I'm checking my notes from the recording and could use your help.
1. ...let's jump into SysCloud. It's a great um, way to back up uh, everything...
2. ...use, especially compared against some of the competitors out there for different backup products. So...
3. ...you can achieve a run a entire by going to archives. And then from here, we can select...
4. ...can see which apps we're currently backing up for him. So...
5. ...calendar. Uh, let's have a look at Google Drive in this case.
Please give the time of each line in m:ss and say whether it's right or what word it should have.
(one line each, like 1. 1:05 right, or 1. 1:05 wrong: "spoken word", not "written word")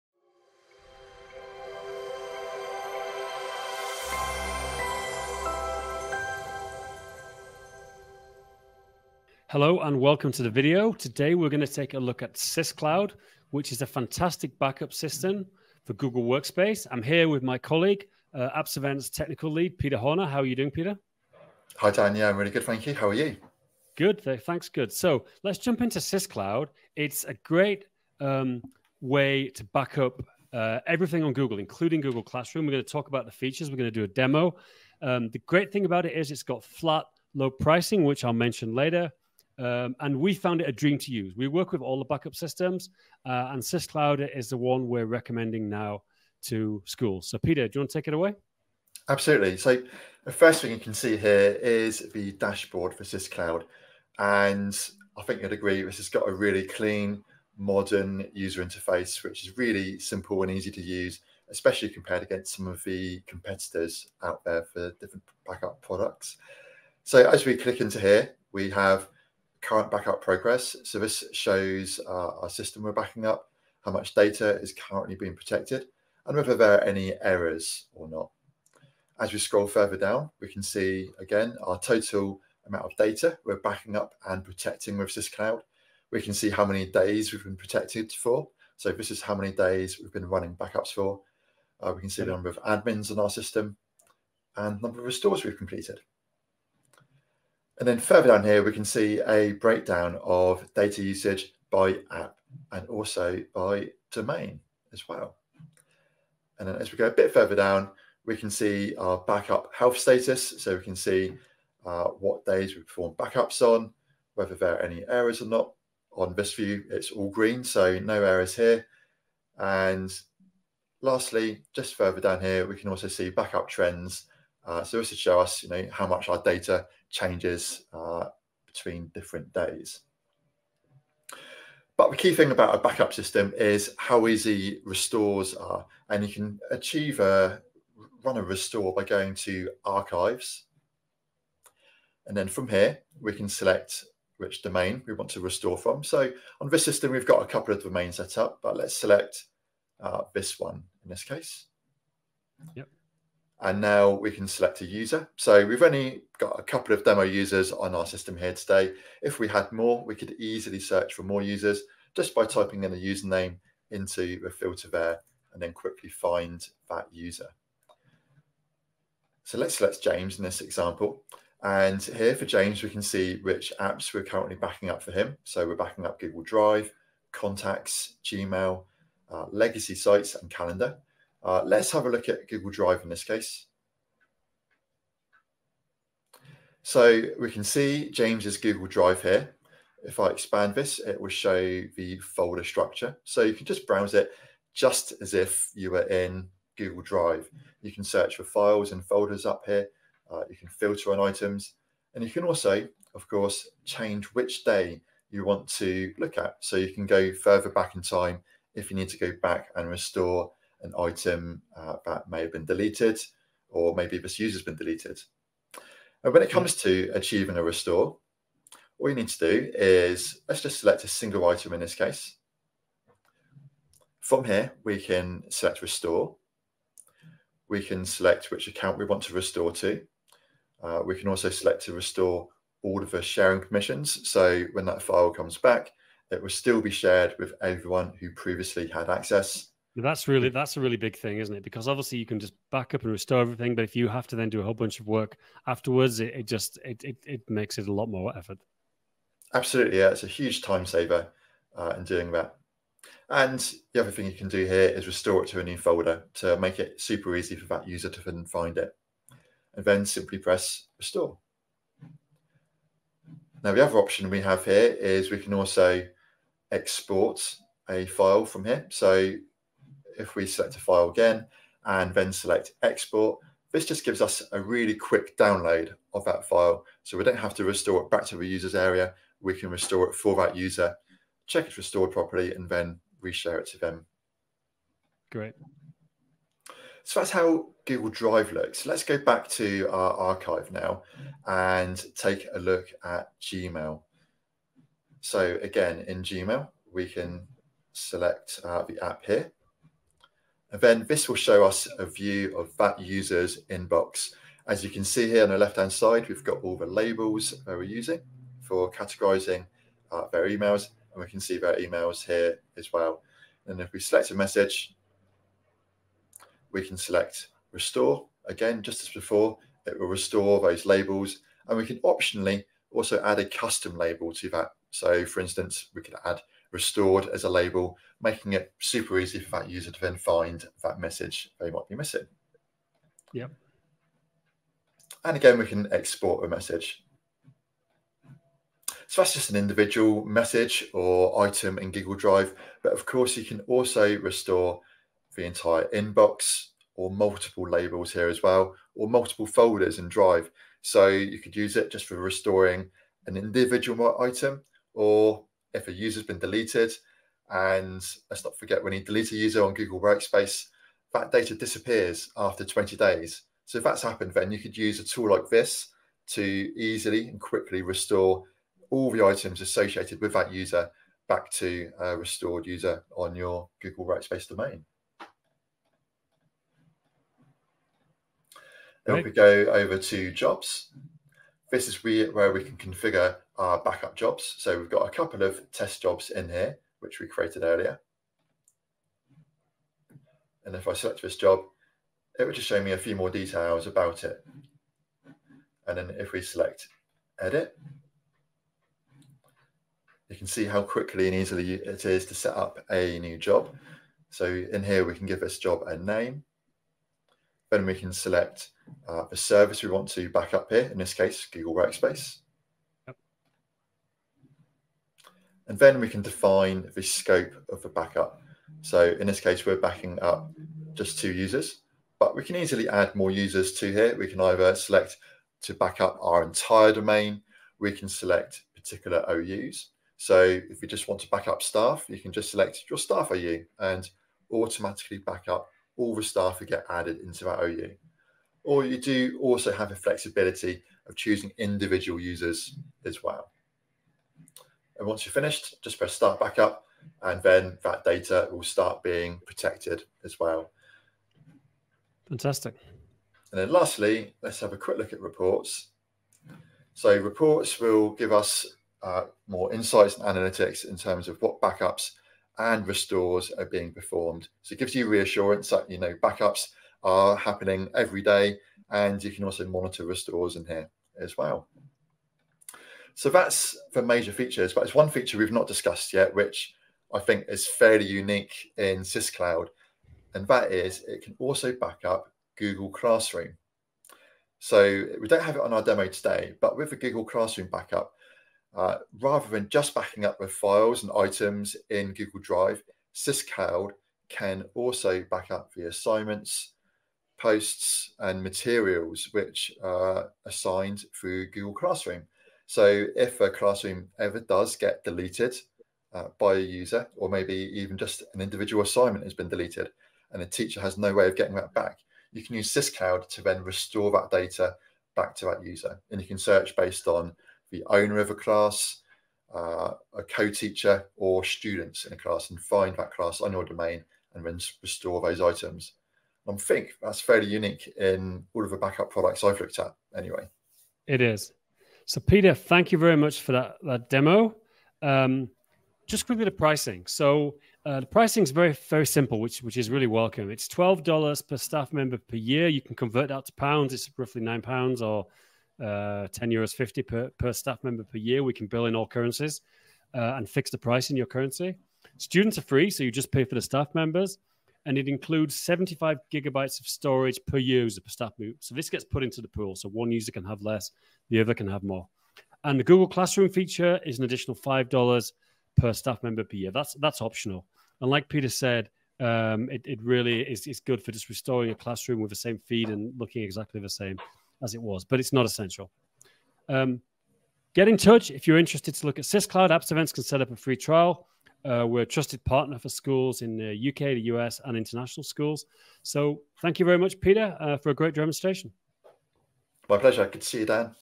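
1. 0:25 right
2. 1:00 right
3. 2:16 wrong: "restore", not "entire"
4. 2:52 right
5. 3:00 right.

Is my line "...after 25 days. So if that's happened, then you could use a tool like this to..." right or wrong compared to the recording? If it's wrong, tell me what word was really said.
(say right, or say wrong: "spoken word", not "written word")
wrong: "20", not "25".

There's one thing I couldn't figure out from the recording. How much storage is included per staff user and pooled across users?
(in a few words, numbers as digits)
75 gigabytes.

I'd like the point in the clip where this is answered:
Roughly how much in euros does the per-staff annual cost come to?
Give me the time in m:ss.
9:06.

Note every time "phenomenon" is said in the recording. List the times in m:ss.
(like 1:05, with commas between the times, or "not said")
not said.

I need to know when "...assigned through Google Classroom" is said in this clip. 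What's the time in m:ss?
8:20.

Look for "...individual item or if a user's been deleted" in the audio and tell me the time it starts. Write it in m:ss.
5:53.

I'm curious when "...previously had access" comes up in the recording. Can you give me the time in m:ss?
3:58.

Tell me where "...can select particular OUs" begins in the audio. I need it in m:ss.
7:07.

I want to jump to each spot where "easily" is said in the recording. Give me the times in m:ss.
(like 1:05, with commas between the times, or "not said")
2:40, 6:06, 6:41, 7:02.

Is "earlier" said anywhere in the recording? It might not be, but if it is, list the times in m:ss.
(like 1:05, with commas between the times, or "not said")
6:27.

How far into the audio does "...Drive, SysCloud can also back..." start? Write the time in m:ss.
8:12.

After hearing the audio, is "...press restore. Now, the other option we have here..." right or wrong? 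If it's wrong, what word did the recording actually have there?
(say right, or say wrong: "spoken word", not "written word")
right.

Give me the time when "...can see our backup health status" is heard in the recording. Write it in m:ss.
1:48.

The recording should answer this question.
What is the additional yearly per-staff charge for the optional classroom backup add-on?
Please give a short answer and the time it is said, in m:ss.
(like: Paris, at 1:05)
$5, at 9:24.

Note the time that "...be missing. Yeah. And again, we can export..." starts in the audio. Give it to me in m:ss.
5:31.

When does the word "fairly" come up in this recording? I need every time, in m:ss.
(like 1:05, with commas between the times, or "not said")
7:57, 8:47.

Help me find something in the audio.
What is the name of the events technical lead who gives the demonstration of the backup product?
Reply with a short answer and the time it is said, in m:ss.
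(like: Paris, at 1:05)
Peter Horner, at 0:19.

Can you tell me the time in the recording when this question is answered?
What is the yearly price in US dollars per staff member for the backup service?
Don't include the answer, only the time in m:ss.
9:00.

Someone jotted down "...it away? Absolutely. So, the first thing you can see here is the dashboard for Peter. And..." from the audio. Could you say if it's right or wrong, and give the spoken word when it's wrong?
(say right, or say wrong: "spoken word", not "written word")
wrong: "SysCloud", not "Peter".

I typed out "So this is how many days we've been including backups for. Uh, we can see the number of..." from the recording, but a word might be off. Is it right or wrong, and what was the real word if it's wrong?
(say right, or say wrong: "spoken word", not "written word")
wrong: "running", not "including".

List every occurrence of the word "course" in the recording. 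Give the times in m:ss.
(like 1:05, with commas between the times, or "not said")
3:23, 5:43.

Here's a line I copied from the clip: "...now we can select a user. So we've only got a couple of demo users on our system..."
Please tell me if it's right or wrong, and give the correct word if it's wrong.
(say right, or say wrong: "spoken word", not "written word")
right.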